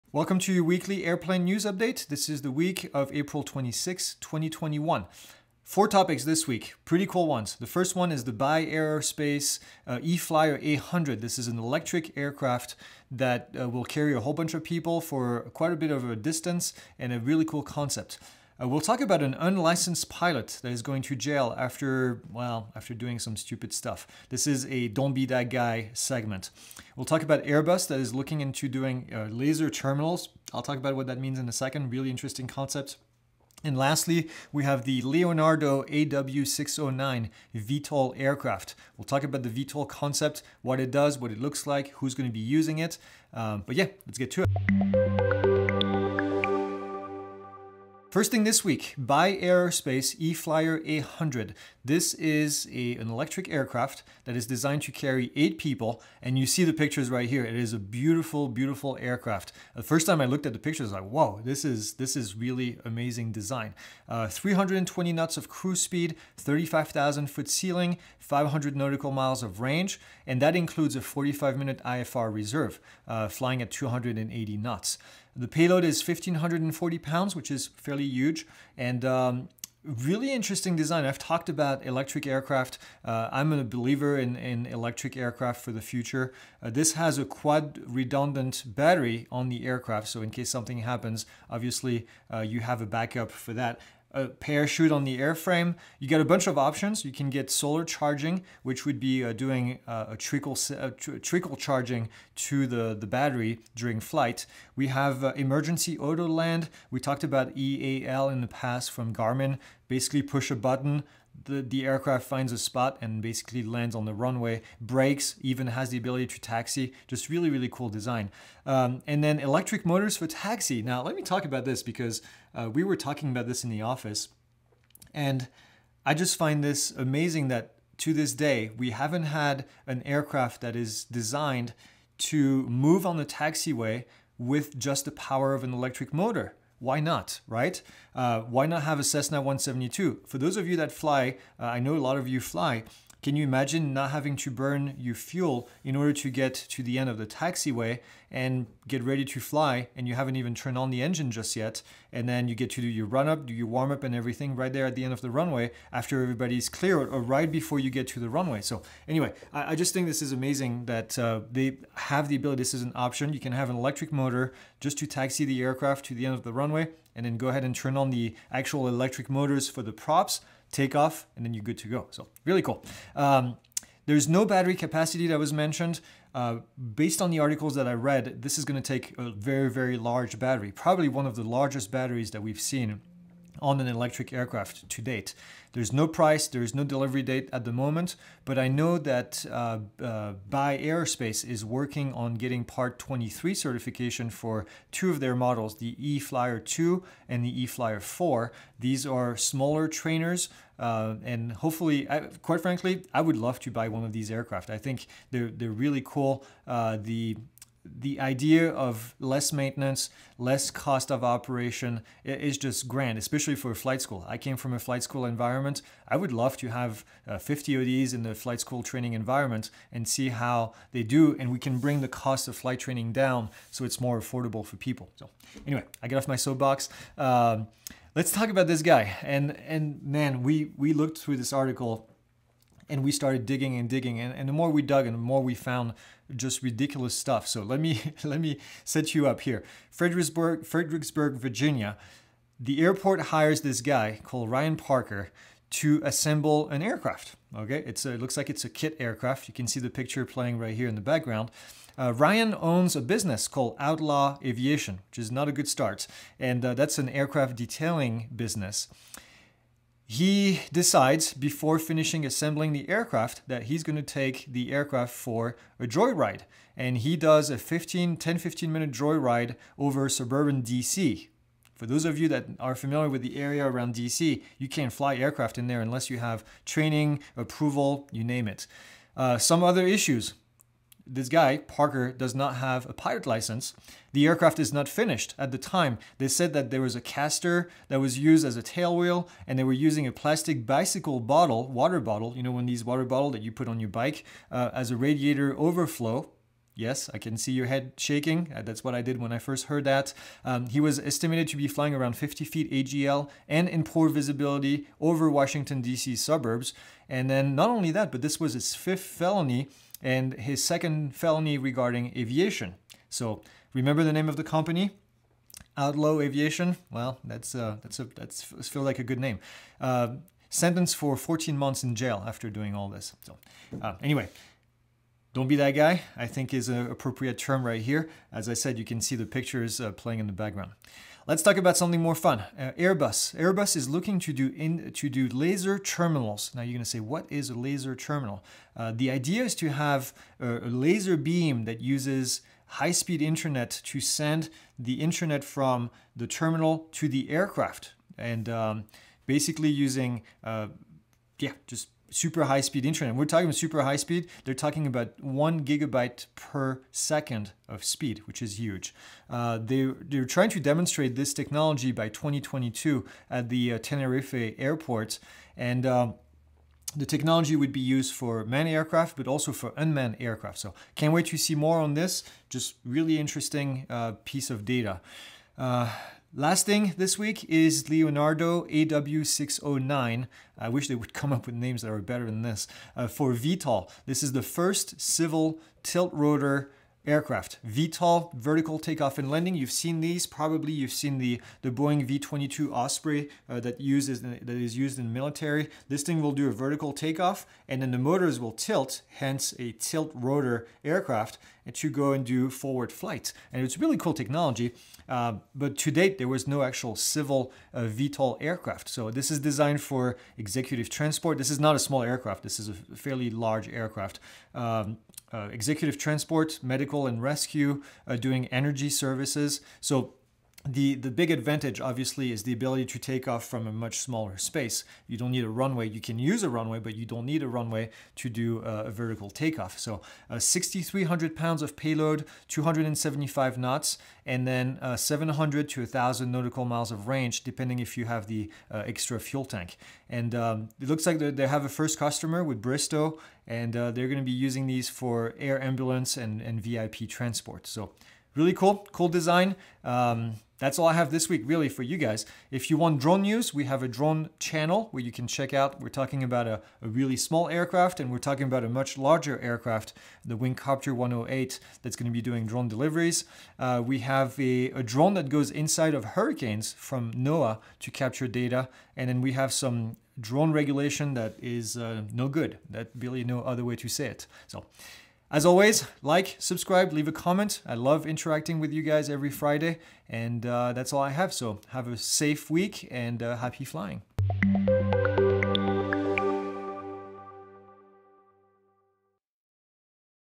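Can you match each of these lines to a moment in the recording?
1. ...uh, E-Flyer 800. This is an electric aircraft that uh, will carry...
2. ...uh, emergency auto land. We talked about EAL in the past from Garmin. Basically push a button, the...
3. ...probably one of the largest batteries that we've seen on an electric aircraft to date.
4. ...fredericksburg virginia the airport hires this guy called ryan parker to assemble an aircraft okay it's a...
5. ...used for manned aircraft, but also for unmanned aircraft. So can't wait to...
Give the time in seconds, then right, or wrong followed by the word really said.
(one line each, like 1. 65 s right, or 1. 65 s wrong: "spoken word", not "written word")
1. 9 s right
2. 105 s right
3. 180 s right
4. 240 s right
5. 367 s right.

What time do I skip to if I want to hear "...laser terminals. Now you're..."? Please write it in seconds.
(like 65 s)
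335 s.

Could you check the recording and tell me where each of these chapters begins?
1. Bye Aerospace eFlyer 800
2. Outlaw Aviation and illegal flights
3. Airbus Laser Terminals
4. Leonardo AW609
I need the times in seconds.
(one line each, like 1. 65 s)
1. 48 s
2. 229 s
3. 333 s
4. 376 s.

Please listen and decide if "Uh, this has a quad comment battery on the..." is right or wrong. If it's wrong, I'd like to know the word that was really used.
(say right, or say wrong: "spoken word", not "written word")
wrong: "redundant", not "comment".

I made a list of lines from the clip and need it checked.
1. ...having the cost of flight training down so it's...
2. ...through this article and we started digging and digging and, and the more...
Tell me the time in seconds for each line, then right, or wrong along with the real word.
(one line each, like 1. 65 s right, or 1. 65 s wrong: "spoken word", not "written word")
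1. 221 s wrong: "bring", not "having"
2. 231 s right.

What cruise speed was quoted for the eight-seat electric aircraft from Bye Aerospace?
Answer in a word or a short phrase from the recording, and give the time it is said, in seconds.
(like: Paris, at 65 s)
320 knots, at 64 s.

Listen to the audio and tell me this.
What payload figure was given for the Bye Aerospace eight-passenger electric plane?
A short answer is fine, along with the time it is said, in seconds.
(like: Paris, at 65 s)
1,540 pounds, at 76 s.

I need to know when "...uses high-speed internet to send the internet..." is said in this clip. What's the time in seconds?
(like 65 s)
341 s.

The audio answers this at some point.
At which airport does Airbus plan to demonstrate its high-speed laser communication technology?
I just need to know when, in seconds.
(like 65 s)
363 s.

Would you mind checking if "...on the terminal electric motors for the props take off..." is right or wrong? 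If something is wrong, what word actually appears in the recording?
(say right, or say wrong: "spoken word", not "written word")
wrong: "actual", not "terminal".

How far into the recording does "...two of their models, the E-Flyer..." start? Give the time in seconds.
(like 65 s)
194 s.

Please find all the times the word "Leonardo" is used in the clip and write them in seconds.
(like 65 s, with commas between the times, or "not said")
35 s, 377 s.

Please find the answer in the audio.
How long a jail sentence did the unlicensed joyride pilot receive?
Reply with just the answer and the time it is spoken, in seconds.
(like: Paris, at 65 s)
14 months, at 321 s.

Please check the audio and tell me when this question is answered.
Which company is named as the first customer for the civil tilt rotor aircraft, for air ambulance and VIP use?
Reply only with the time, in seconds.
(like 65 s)
442 s.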